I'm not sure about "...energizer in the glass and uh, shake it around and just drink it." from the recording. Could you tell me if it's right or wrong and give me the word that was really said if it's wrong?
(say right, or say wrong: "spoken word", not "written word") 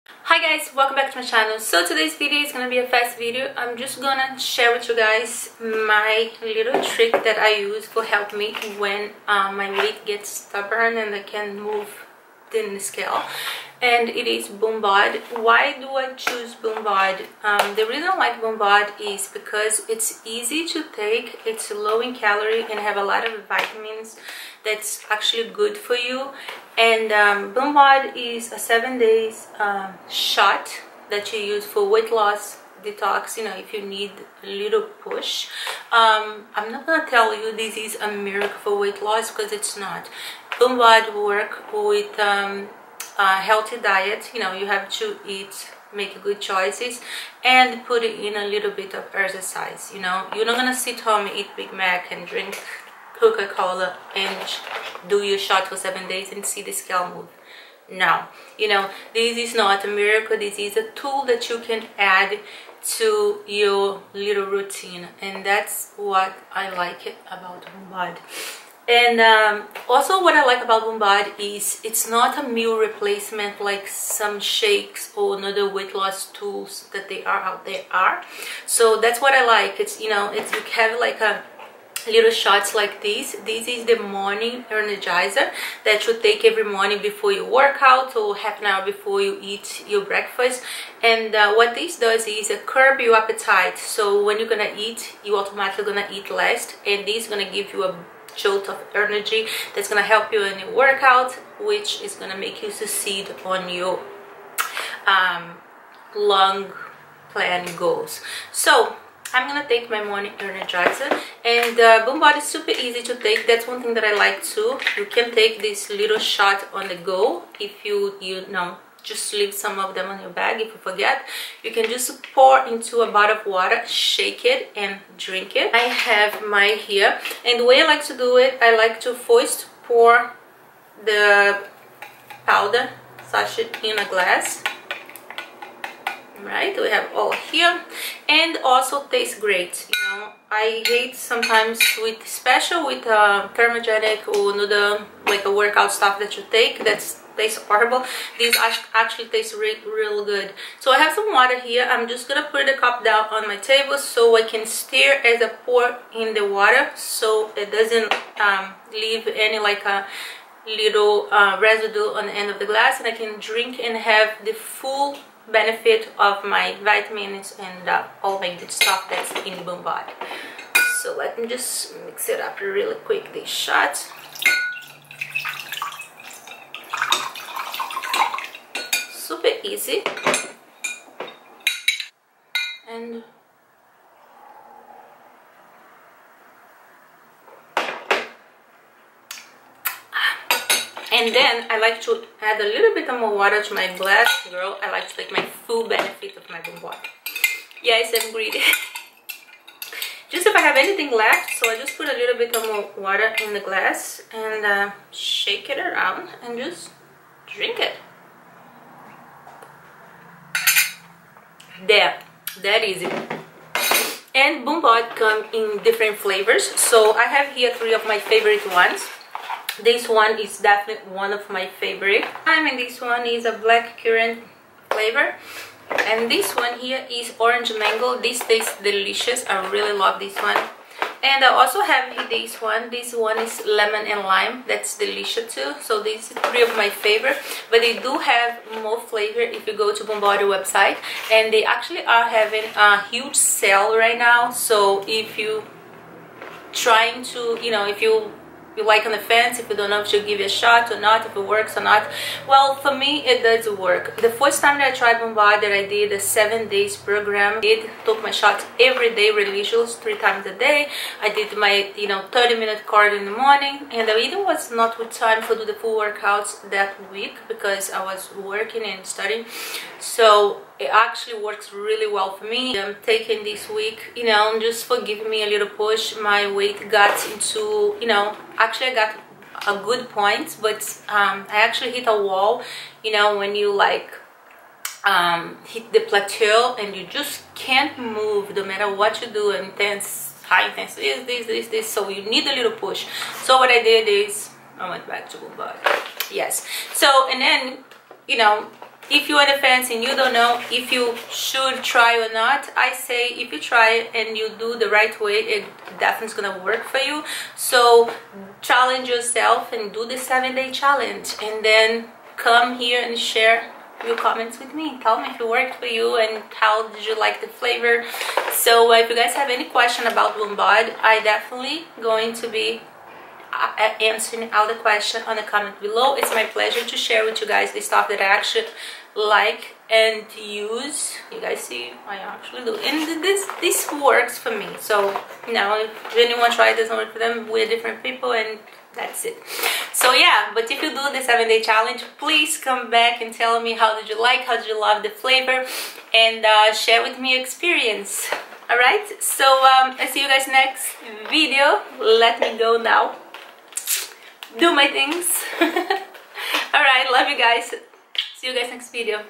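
wrong: "water", not "energizer".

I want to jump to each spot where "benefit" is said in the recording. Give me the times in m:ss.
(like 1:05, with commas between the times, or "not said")
2:45, 3:15.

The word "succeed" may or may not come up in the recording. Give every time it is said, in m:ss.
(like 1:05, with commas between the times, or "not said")
1:42.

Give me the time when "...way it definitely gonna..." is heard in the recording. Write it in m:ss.
5:05.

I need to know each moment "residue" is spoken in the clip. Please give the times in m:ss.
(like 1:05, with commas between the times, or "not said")
2:41.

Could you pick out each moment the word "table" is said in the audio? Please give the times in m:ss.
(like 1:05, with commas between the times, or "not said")
2:33.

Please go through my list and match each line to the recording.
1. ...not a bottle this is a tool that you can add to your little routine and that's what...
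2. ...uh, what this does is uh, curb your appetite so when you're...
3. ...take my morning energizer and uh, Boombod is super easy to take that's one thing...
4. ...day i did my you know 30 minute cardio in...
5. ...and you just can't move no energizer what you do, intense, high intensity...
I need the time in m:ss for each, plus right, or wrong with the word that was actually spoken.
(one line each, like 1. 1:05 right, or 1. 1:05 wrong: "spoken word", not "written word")
1. 0:59 wrong: "miracle", not "bottle"
2. 1:31 right
3. 1:49 right
4. 4:20 right
5. 4:46 wrong: "matter", not "energizer".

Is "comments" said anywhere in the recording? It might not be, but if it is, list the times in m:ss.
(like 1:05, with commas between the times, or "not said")
5:14, 5:25.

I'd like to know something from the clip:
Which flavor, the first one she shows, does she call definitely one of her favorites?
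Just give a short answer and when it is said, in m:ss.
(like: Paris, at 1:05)
black currant, at 3:43.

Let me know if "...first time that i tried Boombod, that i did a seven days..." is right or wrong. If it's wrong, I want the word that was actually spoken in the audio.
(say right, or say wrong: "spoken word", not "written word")
right.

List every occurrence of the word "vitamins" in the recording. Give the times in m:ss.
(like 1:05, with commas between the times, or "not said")
0:23, 2:46.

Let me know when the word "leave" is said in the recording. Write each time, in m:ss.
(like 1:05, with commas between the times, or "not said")
1:59, 2:38.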